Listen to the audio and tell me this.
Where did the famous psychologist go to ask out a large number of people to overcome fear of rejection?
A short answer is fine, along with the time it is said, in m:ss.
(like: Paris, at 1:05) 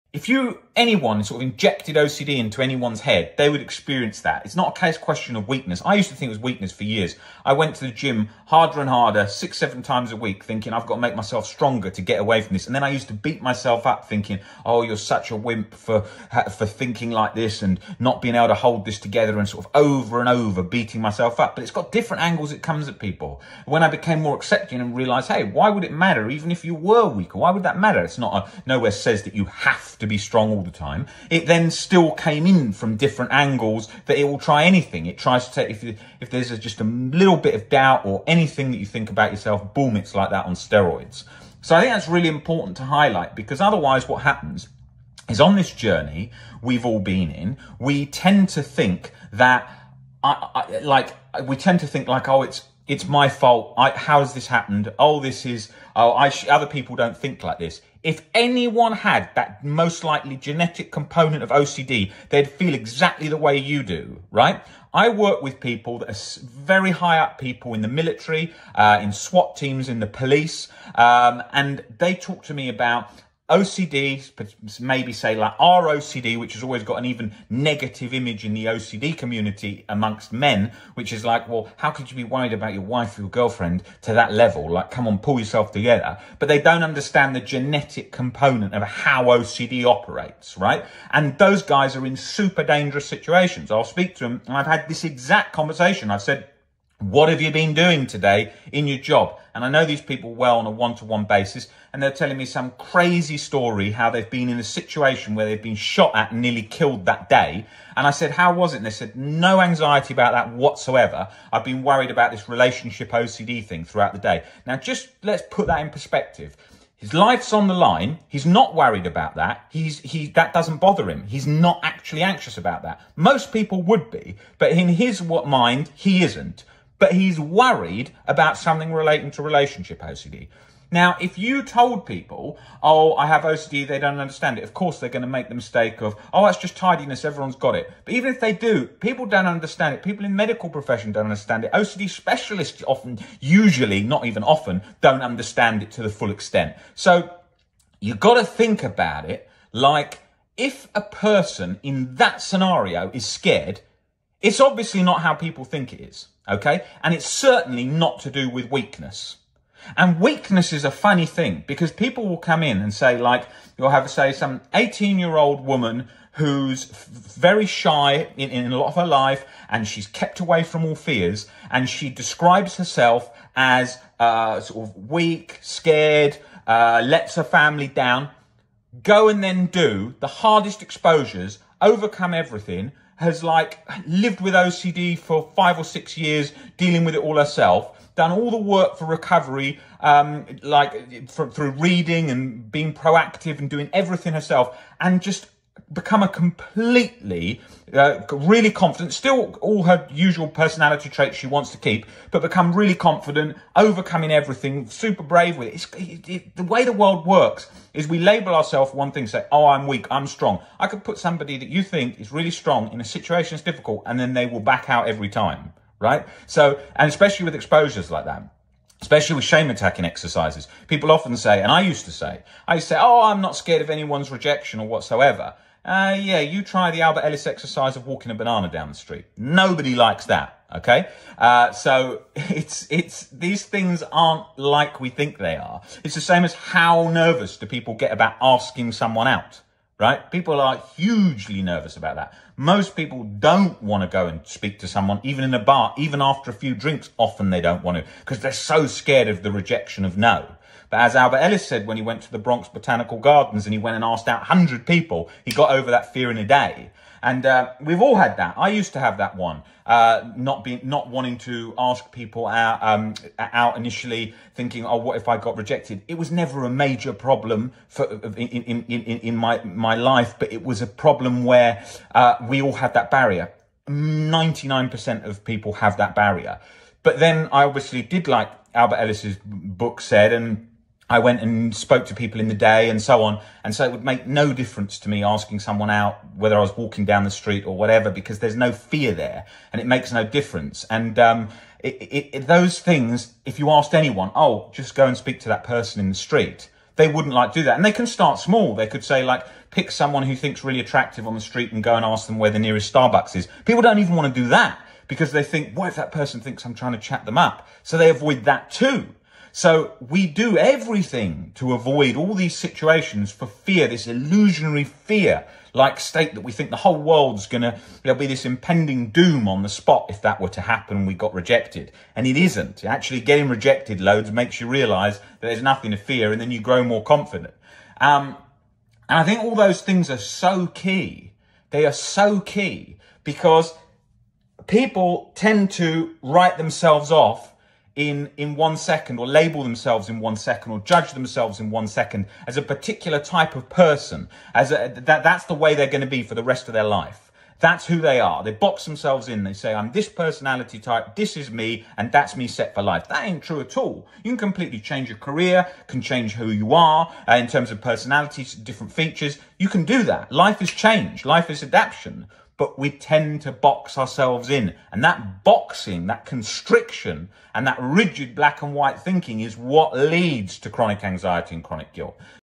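Bronx Botanical Gardens, at 4:12.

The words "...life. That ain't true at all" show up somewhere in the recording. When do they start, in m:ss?
5:52.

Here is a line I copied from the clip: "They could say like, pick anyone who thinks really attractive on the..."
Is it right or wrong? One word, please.
wrong.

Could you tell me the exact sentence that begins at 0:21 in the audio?
But it's got different angles it comes at people.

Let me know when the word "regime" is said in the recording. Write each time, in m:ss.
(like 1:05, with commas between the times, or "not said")
not said.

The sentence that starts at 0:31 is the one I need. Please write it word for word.
It then still came in from different angles that it will try anything.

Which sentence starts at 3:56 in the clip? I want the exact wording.
It's the same as how nervous do people get about asking someone out, right?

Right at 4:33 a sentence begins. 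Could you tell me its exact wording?
Ninety nine percent of people have that barrier.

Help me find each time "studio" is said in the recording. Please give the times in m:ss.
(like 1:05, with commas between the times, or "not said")
not said.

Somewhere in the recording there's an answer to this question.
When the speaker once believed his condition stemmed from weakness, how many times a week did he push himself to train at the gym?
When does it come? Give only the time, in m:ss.
0:09.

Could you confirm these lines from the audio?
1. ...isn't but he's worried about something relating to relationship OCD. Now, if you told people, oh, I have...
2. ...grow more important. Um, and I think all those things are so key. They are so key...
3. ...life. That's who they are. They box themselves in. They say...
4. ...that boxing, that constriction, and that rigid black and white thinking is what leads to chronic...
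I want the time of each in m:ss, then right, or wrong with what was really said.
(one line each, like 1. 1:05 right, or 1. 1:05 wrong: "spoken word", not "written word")
1. 2:06 right
2. 5:26 wrong: "confident", not "important"
3. 5:46 right
4. 6:05 right.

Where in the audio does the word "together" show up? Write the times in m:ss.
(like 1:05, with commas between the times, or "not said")
0:18, 1:25.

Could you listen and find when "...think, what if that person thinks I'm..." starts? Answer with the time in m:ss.
5:05.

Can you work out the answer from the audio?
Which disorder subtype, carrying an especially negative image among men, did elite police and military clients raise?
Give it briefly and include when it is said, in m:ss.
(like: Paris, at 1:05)
ROCD, at 1:15.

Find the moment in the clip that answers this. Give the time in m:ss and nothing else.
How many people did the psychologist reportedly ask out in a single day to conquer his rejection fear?
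4:14.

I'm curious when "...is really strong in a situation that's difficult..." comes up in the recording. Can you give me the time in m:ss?
3:32.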